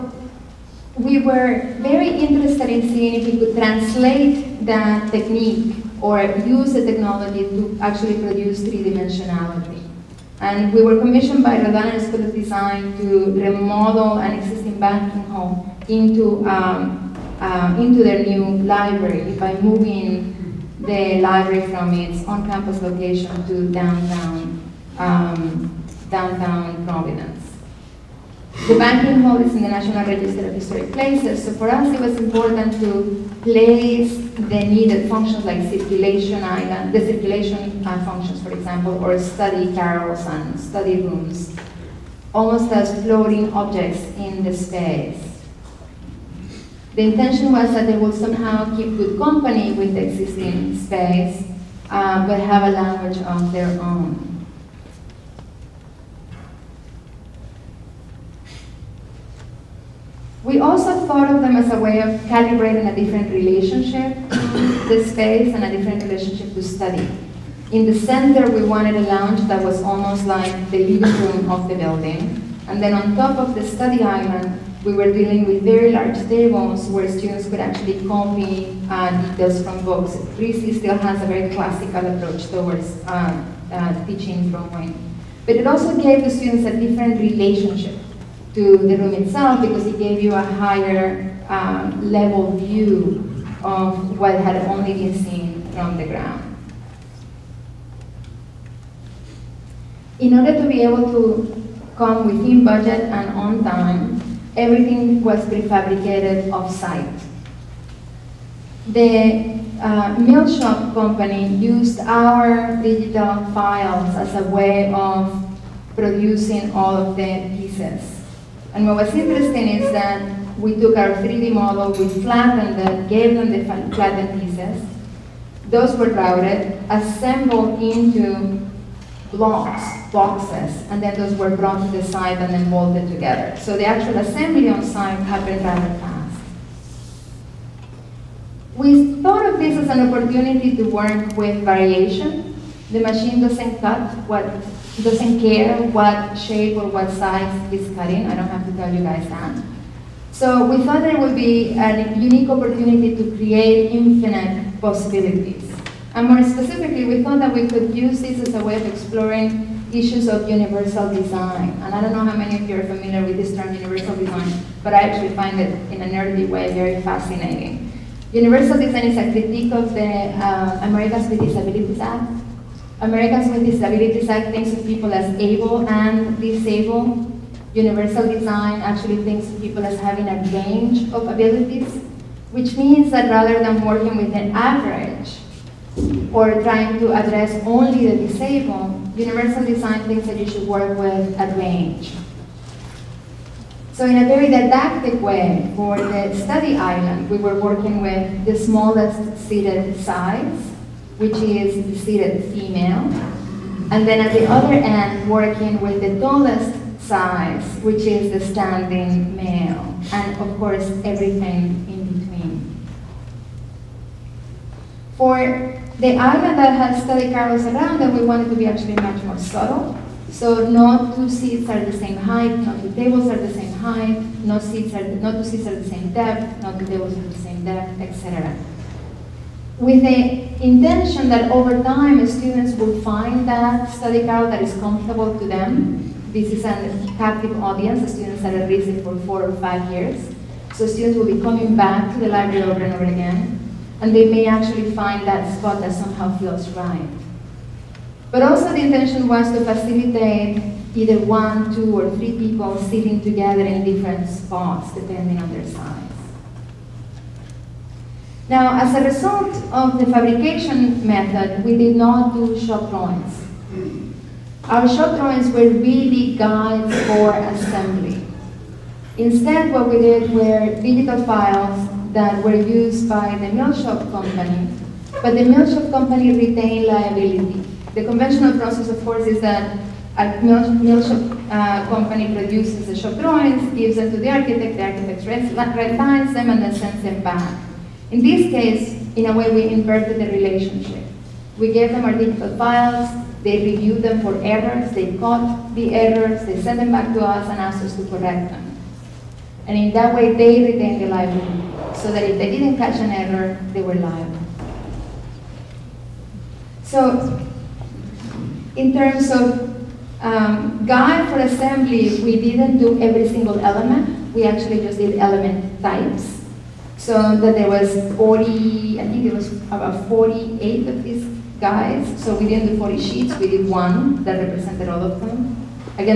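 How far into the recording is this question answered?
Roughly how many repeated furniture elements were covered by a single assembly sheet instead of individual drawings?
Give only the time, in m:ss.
5:20.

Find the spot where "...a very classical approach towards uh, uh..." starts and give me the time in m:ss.
1:21.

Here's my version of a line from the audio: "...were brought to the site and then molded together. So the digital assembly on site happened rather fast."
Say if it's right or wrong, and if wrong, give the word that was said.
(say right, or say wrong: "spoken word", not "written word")
wrong: "actual", not "digital".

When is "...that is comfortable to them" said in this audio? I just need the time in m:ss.
3:54.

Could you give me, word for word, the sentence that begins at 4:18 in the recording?
Now, as a result of the fabrication method, we did not do shop drawings.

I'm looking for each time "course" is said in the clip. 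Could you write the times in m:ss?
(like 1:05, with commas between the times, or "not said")
3:30, 4:39.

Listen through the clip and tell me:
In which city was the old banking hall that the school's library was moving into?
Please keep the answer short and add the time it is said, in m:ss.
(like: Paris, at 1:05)
Providence, at 0:26.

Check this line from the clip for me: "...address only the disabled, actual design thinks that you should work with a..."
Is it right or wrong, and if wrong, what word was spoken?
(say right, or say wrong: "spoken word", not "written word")
wrong: "universal", not "actual".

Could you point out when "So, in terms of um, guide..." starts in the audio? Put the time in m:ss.
5:06.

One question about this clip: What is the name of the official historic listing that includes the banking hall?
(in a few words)
National Register of Historic Places.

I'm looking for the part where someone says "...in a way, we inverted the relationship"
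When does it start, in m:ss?
4:49.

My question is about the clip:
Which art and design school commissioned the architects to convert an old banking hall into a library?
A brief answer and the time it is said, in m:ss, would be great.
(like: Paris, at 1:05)
Rhode Island School of Design, at 0:11.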